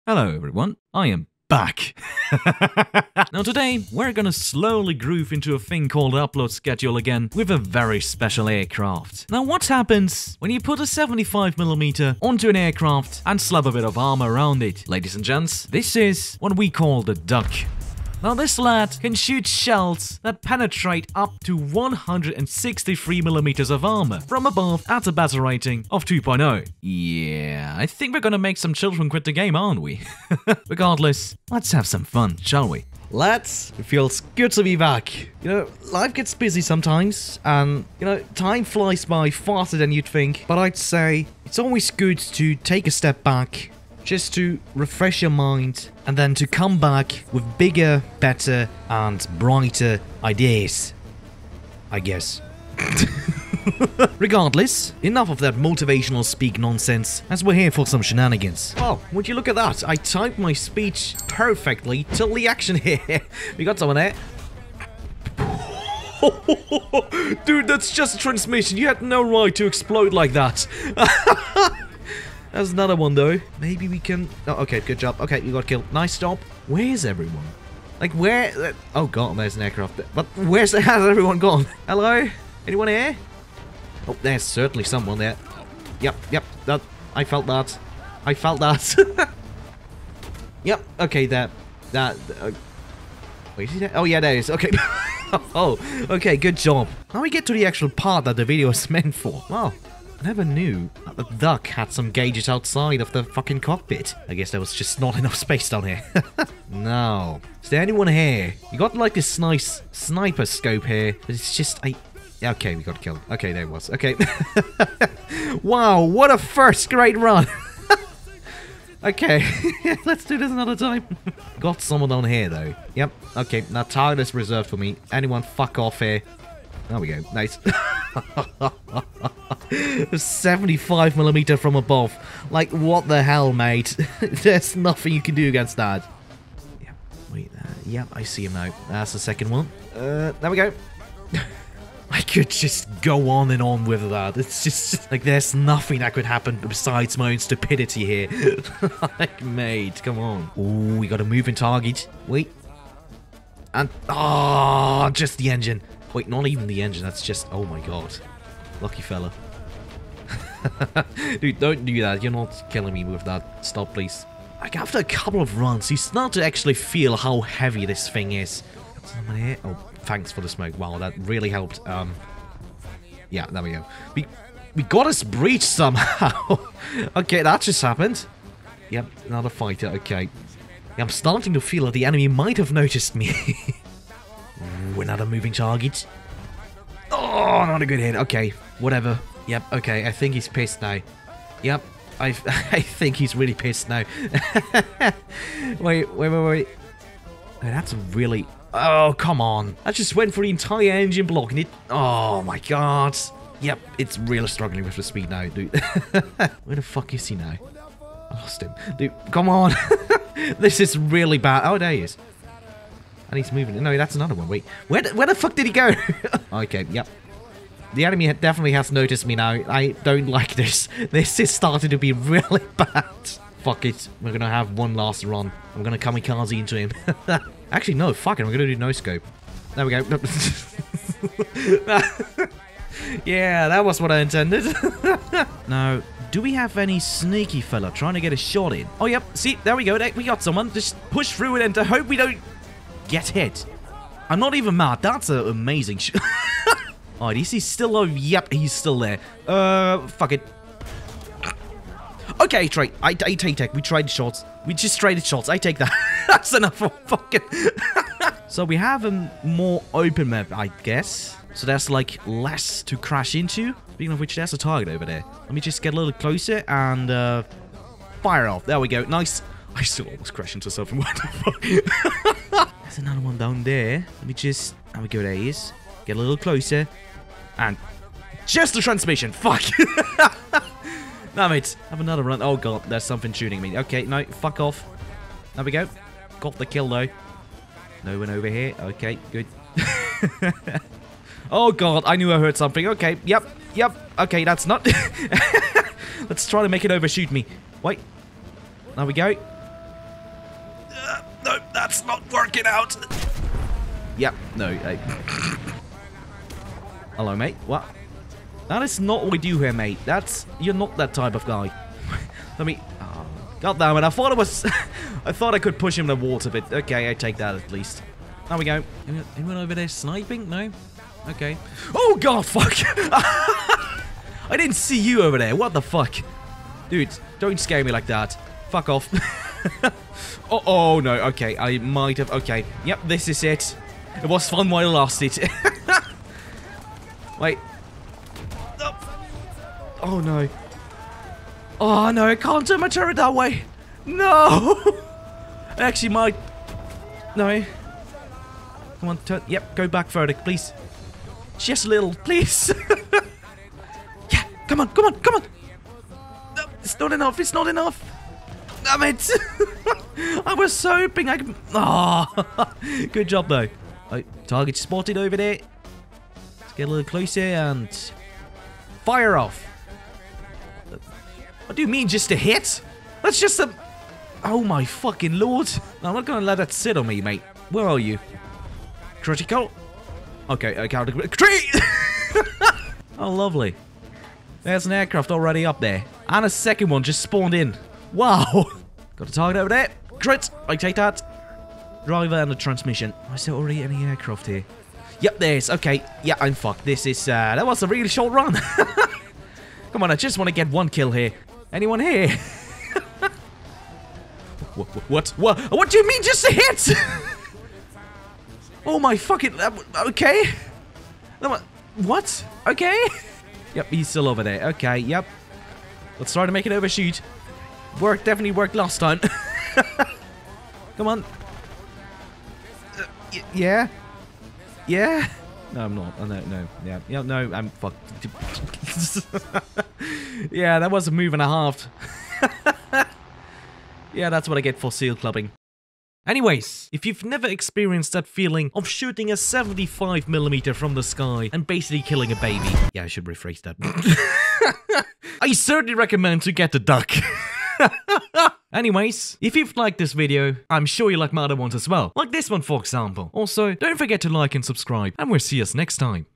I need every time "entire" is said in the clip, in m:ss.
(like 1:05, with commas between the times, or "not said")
3:20.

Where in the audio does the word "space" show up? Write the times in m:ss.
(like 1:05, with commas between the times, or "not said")
1:45.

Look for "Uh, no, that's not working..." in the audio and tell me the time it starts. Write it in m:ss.
4:59.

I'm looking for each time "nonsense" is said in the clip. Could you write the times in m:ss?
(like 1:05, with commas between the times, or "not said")
0:56.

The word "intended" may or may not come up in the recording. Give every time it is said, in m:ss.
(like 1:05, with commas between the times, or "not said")
3:54.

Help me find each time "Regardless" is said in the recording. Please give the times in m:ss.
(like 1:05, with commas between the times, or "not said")
0:30, 0:54.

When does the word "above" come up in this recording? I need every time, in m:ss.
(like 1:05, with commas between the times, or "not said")
0:24, 2:11.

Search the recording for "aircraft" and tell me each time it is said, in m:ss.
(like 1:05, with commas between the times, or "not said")
0:08, 0:12, 1:19, 6:24, 6:34.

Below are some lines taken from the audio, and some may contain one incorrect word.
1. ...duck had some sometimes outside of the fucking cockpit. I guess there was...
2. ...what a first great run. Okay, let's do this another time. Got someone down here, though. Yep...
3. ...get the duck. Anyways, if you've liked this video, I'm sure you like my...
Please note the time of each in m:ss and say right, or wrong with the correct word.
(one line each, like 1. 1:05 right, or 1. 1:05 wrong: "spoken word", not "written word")
1. 1:41 wrong: "gauges", not "sometimes"
2. 1:56 right
3. 7:26 right.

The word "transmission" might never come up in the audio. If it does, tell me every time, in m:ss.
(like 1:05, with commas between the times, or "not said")
1:08, 4:38, 6:32.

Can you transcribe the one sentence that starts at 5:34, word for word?
It was fun while it lasted.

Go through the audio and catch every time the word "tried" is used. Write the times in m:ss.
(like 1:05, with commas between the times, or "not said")
4:13.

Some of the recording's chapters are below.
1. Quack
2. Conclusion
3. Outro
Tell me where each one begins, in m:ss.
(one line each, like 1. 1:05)
1. 0:32
2. 7:16
3. 7:28.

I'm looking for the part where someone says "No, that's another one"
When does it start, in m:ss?
3:33.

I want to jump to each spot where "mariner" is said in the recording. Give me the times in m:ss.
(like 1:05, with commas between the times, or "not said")
not said.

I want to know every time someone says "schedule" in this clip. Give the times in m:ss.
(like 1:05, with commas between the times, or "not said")
0:06.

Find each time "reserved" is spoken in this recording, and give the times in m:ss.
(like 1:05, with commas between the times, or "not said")
2:04.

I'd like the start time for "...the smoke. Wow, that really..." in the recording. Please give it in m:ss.
2:50.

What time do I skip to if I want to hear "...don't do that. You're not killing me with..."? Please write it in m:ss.
2:41.